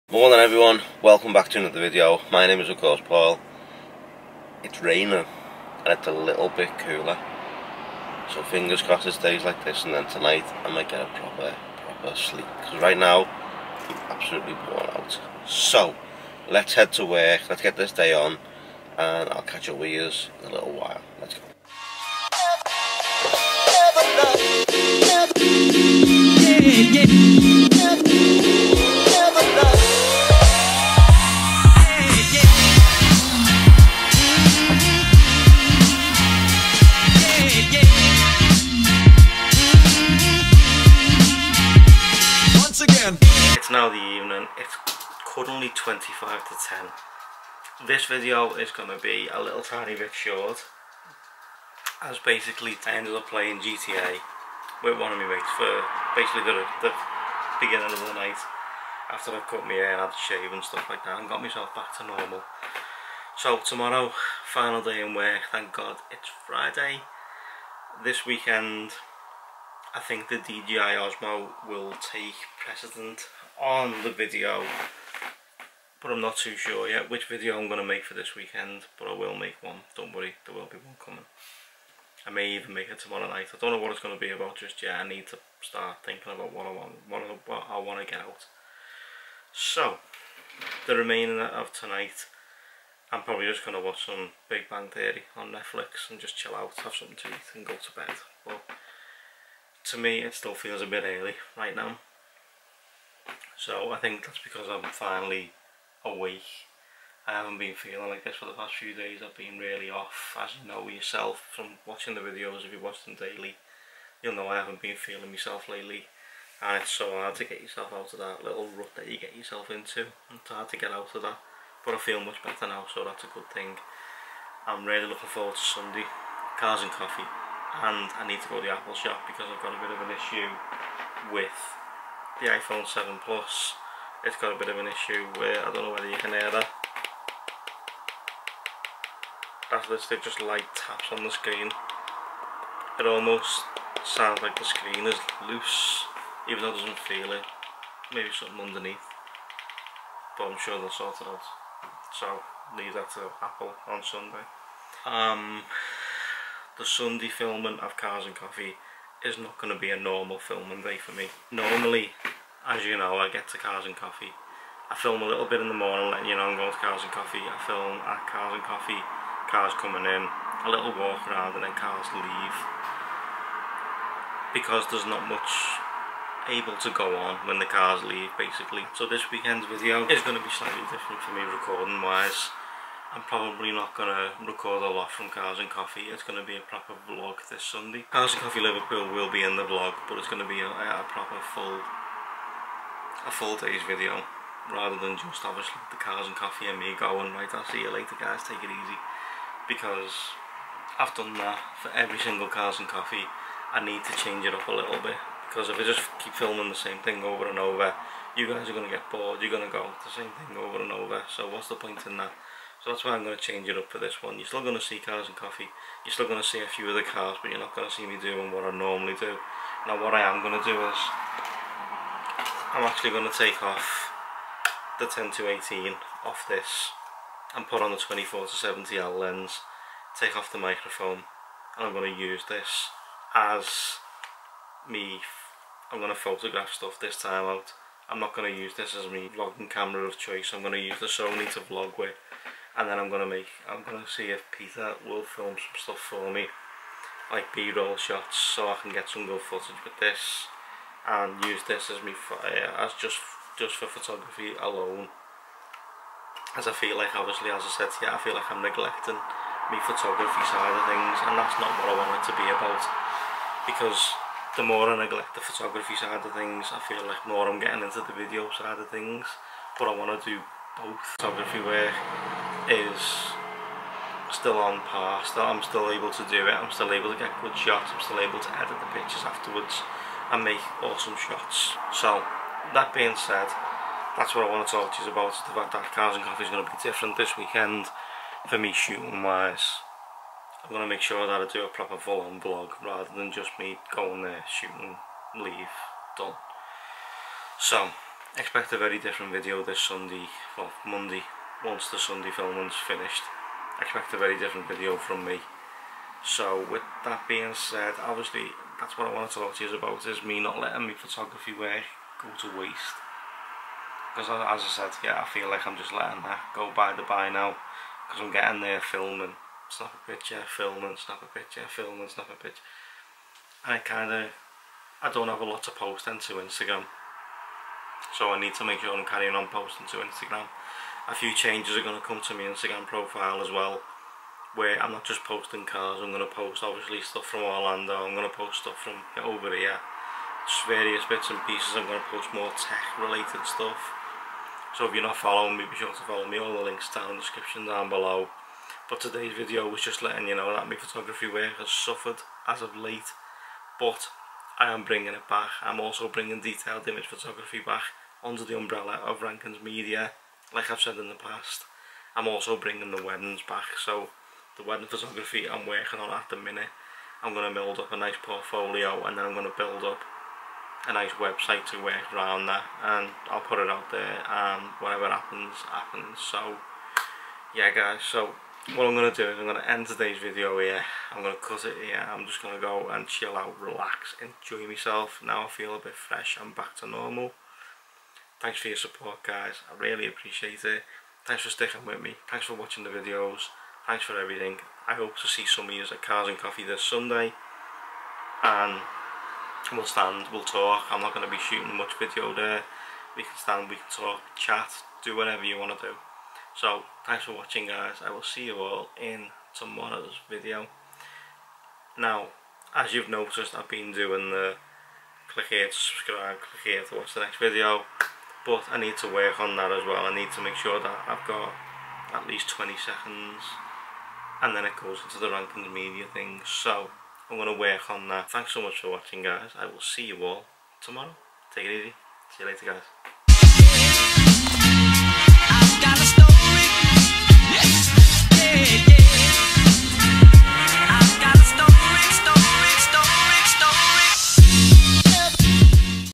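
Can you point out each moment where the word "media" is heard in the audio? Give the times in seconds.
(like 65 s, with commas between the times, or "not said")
359 s, 425 s.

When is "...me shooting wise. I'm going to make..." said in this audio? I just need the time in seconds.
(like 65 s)
288 s.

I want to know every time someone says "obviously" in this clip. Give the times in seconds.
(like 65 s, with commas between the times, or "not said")
195 s, 257 s, 308 s, 336 s.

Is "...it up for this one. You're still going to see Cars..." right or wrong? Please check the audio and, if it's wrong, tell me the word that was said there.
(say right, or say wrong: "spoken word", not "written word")
right.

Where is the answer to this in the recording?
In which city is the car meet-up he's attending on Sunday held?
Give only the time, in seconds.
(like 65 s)
188 s.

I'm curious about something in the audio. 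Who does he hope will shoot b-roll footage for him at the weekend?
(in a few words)
Peter.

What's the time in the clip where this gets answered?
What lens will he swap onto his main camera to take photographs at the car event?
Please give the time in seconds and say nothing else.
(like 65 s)
227 s.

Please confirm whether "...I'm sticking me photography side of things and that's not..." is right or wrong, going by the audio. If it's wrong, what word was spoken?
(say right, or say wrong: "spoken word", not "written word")
wrong: "neglecting", not "sticking".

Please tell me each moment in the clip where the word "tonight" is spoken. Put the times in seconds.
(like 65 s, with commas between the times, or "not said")
10 s, 91 s.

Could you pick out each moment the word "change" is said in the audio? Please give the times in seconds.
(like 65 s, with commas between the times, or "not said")
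204 s, 213 s, 331 s.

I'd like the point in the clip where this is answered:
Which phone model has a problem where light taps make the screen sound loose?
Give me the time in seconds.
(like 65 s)
132 s.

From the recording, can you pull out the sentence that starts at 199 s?
Because I've done that for every single Cars and Coffee.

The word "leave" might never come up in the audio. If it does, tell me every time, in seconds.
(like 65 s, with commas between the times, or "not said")
152 s, 172 s, 178 s, 295 s.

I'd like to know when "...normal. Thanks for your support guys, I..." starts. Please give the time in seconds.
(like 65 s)
386 s.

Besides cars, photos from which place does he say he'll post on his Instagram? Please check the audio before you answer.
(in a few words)
Orlando.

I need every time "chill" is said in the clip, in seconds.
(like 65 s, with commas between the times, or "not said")
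96 s, 383 s.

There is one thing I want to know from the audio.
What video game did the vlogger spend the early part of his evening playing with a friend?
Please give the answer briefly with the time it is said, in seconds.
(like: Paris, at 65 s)
GTA, at 53 s.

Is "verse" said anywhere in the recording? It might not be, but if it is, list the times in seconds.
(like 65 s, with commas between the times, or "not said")
not said.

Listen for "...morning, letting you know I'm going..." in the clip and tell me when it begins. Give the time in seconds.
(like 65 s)
165 s.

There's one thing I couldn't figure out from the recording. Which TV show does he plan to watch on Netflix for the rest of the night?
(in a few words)
Big Bang Theory.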